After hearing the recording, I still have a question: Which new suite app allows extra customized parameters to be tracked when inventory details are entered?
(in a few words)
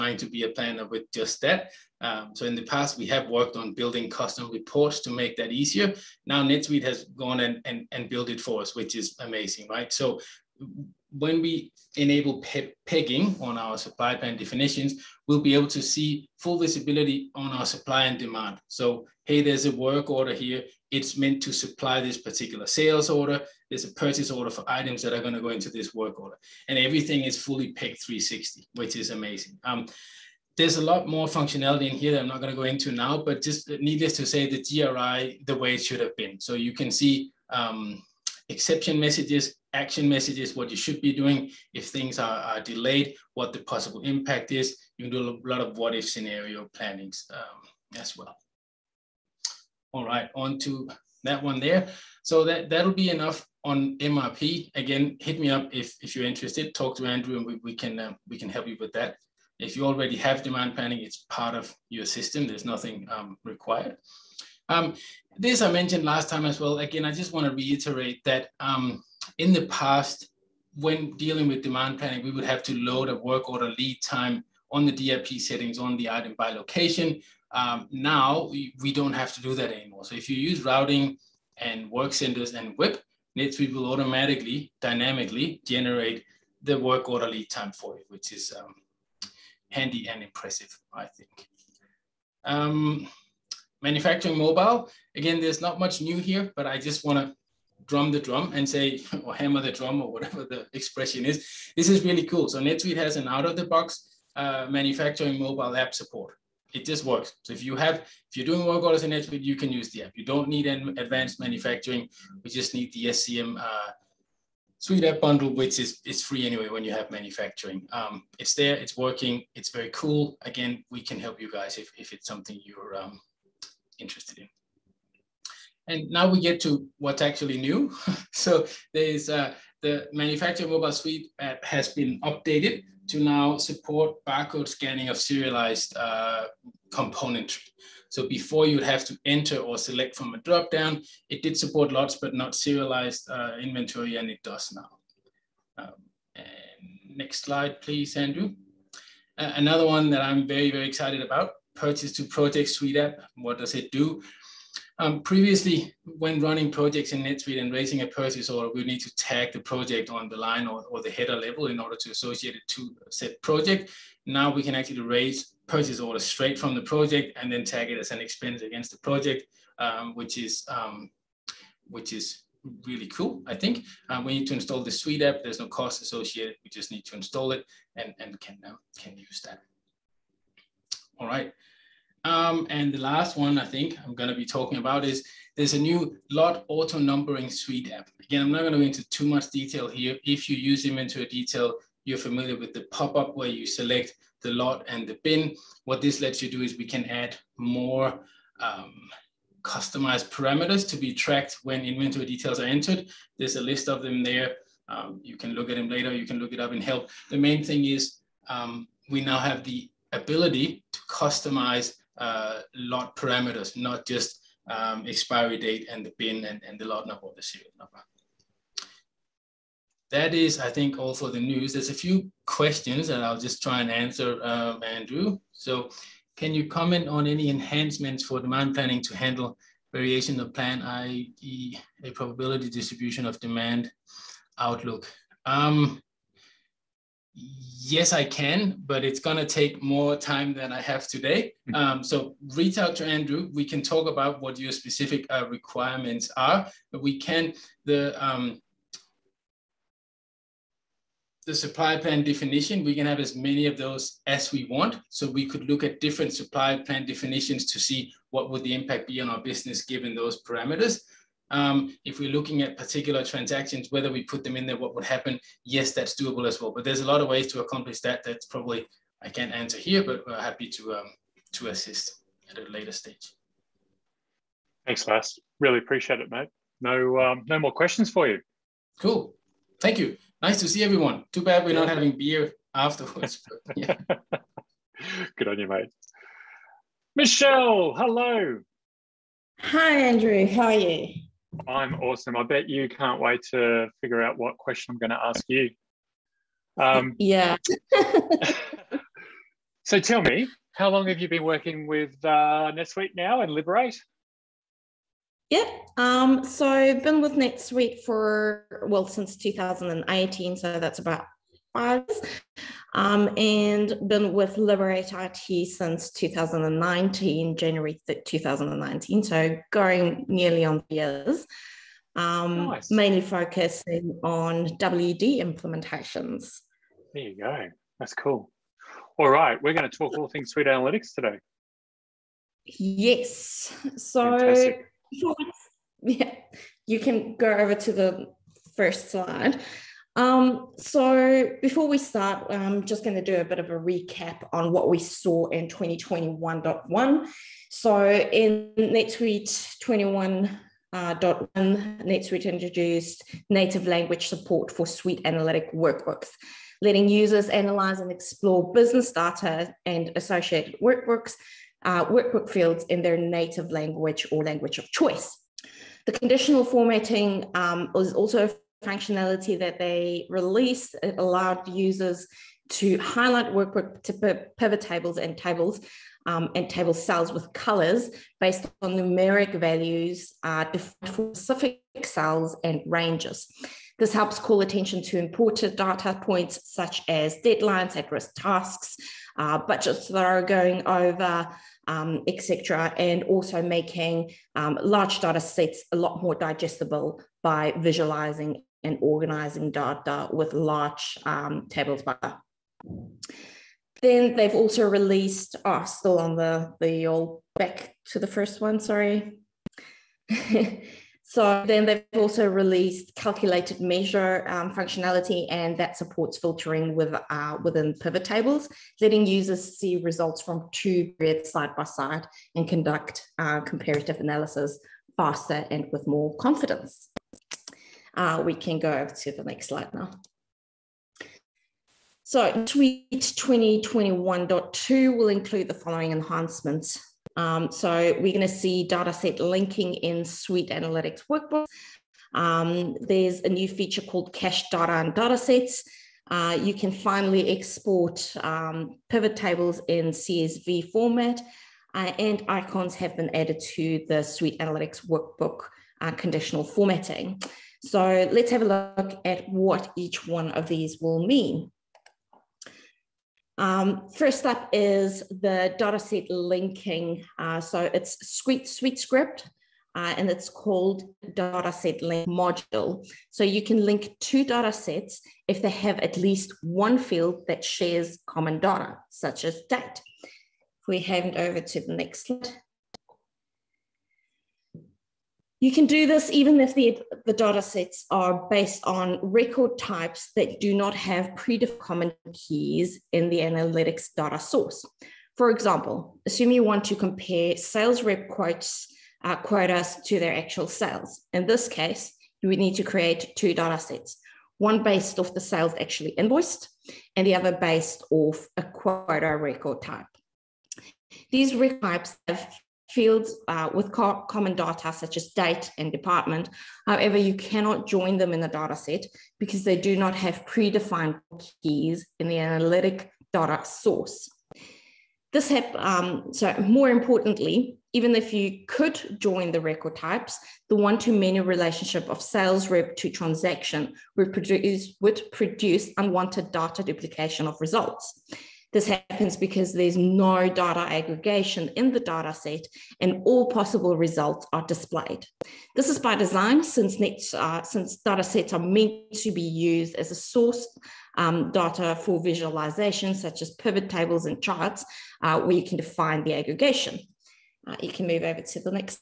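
Lot auto numbering.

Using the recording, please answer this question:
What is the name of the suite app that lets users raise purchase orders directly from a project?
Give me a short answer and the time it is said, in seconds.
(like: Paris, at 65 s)
Purchase to Project, at 151 s.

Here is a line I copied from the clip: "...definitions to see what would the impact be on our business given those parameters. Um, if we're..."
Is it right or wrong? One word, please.
right.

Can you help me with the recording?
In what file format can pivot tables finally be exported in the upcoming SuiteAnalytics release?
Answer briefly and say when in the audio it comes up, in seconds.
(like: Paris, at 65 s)
CSV, at 450 s.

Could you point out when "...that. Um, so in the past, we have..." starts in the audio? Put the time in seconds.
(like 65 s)
1 s.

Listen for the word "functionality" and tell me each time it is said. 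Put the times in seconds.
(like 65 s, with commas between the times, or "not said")
31 s, 368 s, 414 s.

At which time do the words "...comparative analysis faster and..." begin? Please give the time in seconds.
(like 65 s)
423 s.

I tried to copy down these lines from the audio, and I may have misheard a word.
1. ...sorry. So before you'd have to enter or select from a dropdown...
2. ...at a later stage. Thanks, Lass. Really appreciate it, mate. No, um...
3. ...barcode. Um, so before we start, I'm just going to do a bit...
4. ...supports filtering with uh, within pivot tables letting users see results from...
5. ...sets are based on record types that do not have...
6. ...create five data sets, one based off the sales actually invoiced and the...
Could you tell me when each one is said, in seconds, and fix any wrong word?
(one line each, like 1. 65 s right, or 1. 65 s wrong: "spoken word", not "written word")
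1. 136 s wrong: "componentry", not "sorry"
2. 272 s right
3. 339 s wrong: "slide", not "barcode"
4. 415 s right
5. 487 s right
6. 502 s wrong: "two", not "five".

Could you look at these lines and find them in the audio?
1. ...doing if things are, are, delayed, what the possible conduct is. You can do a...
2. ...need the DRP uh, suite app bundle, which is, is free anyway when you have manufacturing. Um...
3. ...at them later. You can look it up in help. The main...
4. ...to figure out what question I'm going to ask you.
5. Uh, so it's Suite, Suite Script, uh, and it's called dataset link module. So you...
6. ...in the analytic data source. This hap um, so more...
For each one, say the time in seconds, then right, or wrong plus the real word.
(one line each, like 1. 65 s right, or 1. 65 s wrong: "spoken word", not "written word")
1. 41 s wrong: "impact", not "conduct"
2. 112 s wrong: "SCM", not "DRP"
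3. 205 s right
4. 293 s right
5. 467 s right
6. 522 s right.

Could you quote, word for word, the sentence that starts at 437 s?
Um, so we're going to see dataset linking in Suite Analytics Workbook.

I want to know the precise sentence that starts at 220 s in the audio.
That is, I think, all for the news.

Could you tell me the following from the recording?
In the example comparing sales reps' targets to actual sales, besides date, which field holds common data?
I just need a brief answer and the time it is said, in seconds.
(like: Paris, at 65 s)
Department, at 515 s.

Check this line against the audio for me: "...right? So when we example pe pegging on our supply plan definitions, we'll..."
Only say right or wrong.
wrong.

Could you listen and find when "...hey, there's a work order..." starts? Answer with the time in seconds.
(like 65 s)
19 s.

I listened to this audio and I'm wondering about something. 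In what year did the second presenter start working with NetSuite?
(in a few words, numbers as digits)
2018.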